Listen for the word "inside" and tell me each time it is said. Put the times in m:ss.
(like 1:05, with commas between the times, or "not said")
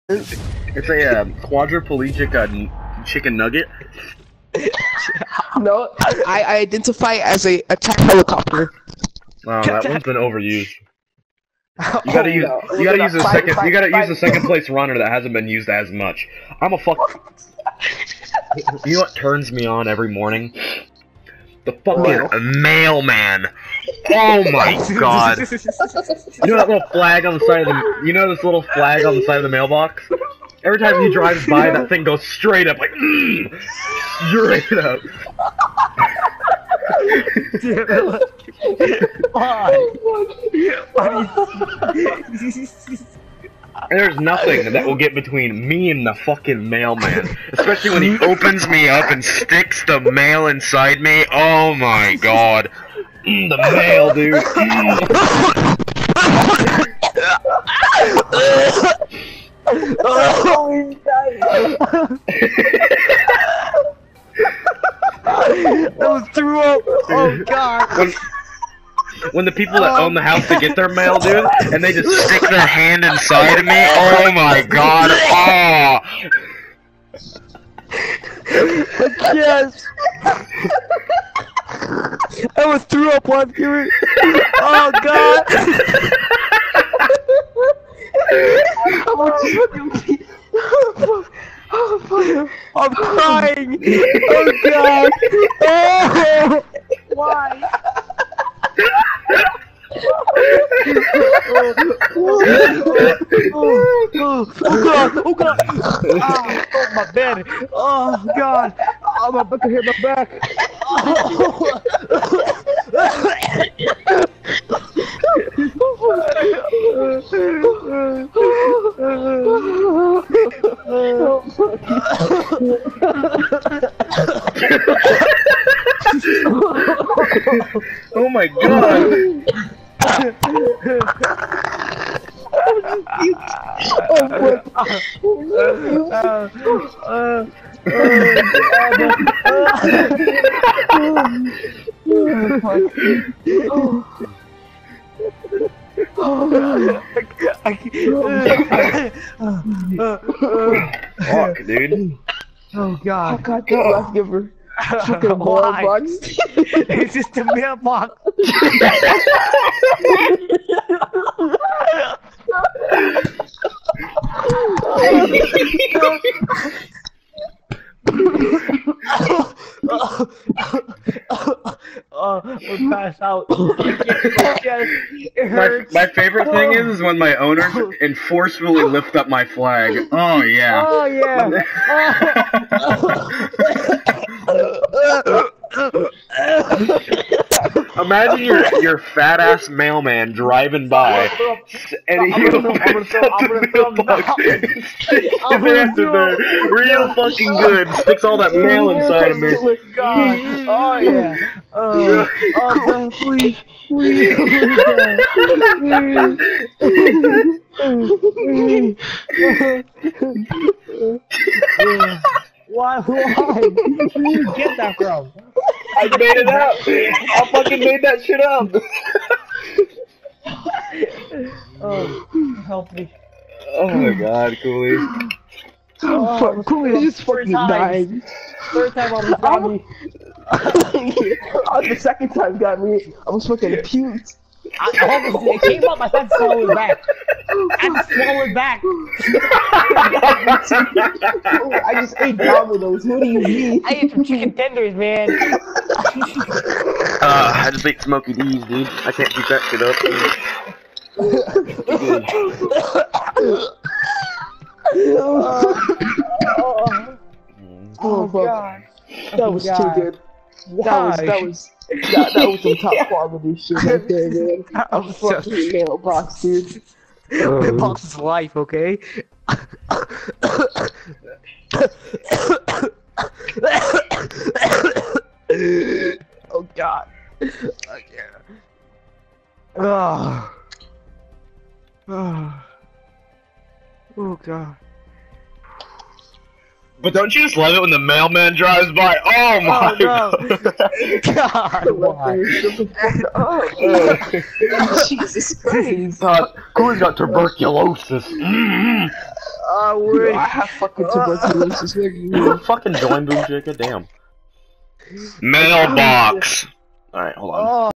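0:50, 1:13, 3:18.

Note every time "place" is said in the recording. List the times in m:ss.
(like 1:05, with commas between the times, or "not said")
0:14.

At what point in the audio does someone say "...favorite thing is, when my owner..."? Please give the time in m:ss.
2:56.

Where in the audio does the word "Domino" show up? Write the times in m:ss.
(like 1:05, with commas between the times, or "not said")
4:02.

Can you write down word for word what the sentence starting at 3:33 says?
Where did you get that from?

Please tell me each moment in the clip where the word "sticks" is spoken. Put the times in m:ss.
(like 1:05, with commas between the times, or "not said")
0:49, 1:12, 3:17.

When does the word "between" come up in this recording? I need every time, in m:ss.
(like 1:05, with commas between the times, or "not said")
0:45.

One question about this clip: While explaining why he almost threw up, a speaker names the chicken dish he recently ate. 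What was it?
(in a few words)
chicken tenders.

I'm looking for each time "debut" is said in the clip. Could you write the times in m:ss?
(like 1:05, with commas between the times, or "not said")
not said.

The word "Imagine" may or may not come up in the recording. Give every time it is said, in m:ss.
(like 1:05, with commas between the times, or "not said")
3:08.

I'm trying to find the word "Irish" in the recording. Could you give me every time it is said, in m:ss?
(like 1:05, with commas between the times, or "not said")
not said.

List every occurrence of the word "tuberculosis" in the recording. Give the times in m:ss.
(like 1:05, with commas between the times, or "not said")
4:57, 5:01.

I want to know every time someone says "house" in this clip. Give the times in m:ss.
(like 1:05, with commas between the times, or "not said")
1:10.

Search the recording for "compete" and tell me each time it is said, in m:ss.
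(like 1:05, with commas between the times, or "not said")
not said.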